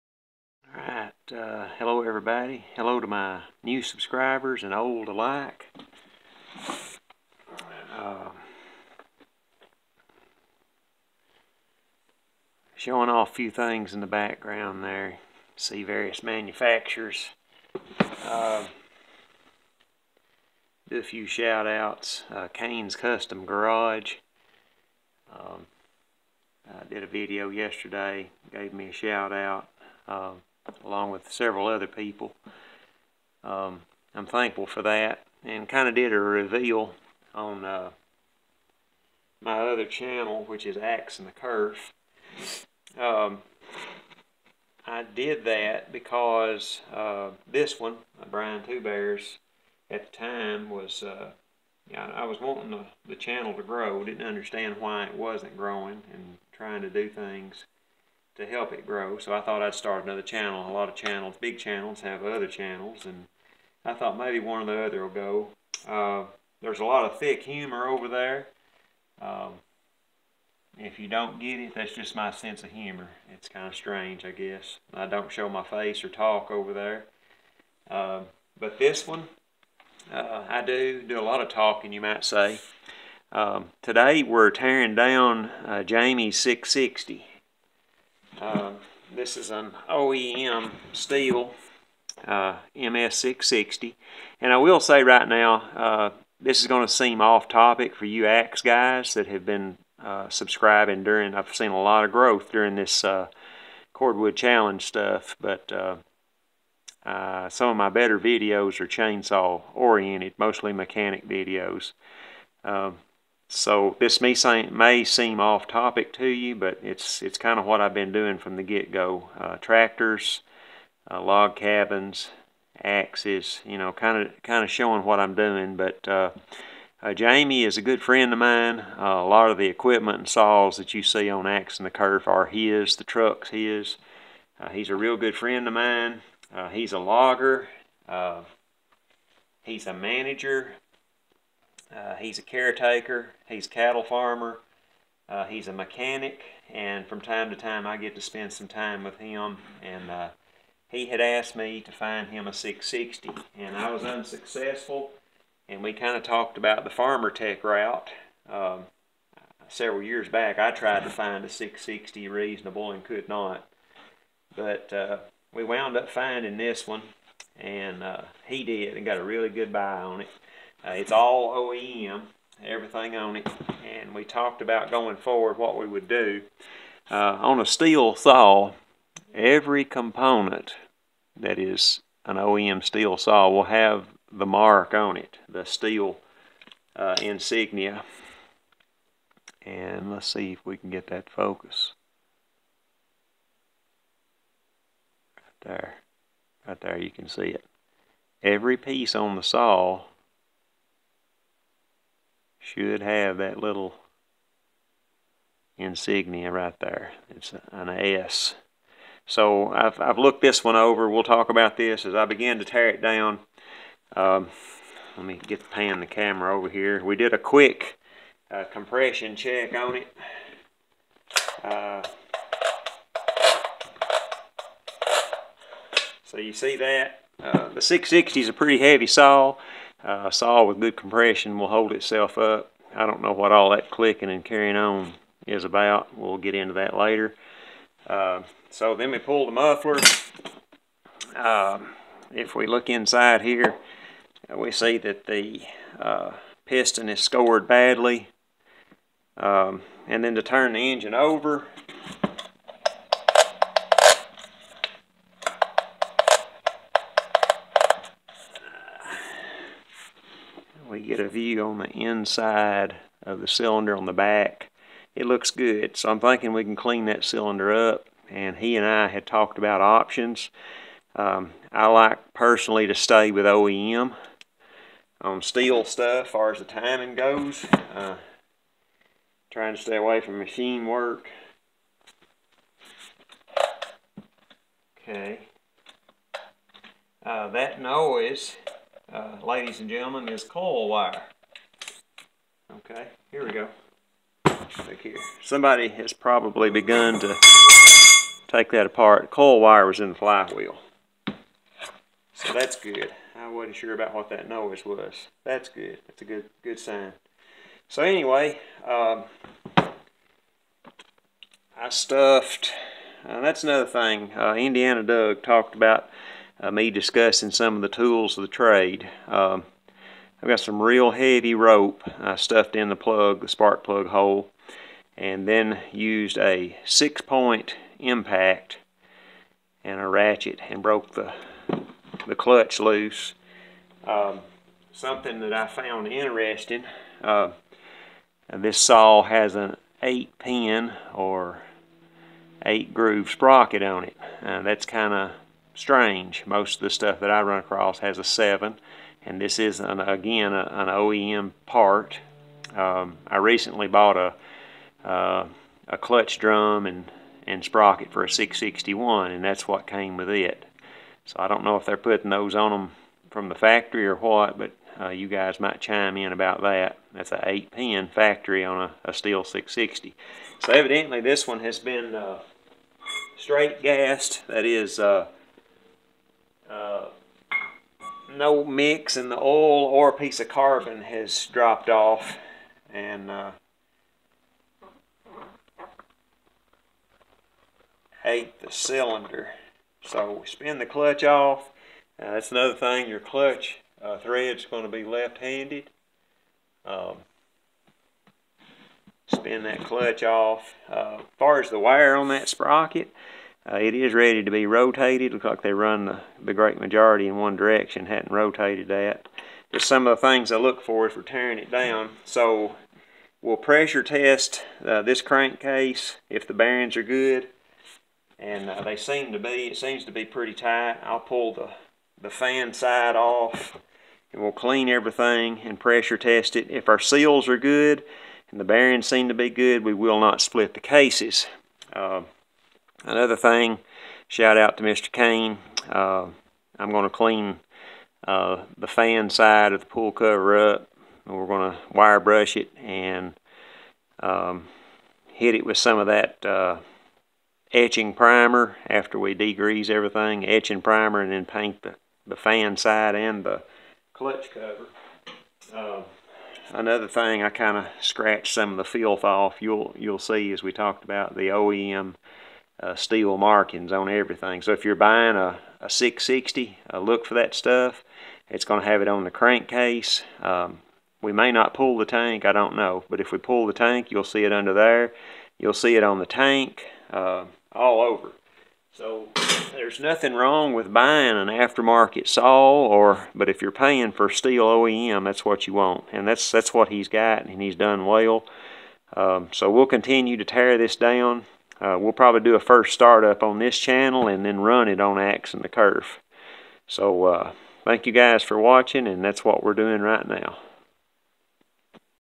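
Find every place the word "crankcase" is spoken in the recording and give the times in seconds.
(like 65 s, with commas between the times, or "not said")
415 s, 469 s.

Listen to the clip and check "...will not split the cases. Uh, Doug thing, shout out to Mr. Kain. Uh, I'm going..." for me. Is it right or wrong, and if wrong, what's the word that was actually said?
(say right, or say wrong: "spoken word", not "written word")
wrong: "Another", not "Doug".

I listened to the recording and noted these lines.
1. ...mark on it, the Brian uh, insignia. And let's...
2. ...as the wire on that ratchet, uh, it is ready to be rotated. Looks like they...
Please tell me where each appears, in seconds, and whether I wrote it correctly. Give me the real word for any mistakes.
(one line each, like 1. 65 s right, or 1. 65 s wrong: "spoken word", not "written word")
1. 184 s wrong: "Stihl", not "Brian"
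2. 401 s wrong: "sprocket", not "ratchet".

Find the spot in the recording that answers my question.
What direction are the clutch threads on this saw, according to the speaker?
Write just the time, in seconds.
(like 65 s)
395 s.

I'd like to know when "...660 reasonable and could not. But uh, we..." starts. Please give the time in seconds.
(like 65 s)
161 s.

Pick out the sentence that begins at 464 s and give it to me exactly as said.
So if you're buying a, a 660, uh, look for that stuff.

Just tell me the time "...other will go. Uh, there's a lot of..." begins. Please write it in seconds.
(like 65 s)
64 s.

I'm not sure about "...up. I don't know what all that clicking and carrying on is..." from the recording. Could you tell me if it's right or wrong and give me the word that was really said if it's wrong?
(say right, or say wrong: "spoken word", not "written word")
right.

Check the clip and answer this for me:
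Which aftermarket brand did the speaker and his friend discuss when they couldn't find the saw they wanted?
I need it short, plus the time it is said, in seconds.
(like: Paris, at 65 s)
Farmertec, at 156 s.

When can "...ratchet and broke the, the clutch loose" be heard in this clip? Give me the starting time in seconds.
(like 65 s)
330 s.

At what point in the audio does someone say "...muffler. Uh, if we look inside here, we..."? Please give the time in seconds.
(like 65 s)
239 s.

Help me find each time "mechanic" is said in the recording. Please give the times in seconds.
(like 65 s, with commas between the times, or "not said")
110 s, 145 s.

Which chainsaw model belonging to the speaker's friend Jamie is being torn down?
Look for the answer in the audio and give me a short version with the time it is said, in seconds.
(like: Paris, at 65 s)
MS660, at 92 s.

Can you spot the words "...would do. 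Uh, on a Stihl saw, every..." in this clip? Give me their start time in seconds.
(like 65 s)
175 s.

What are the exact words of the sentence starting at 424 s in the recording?
And we'll clean everything and pressure test it.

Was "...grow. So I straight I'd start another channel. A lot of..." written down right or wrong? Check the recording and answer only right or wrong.
wrong.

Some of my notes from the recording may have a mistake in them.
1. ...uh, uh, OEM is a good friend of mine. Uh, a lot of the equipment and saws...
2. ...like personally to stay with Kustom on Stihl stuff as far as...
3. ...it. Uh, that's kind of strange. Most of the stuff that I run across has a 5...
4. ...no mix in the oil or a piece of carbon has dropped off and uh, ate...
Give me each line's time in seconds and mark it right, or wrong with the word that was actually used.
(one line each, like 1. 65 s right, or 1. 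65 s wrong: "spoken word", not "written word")
1. 126 s wrong: "Jamie", not "OEM"
2. 271 s wrong: "OEM", not "Kustom"
3. 344 s wrong: "7", not "5"
4. 378 s right.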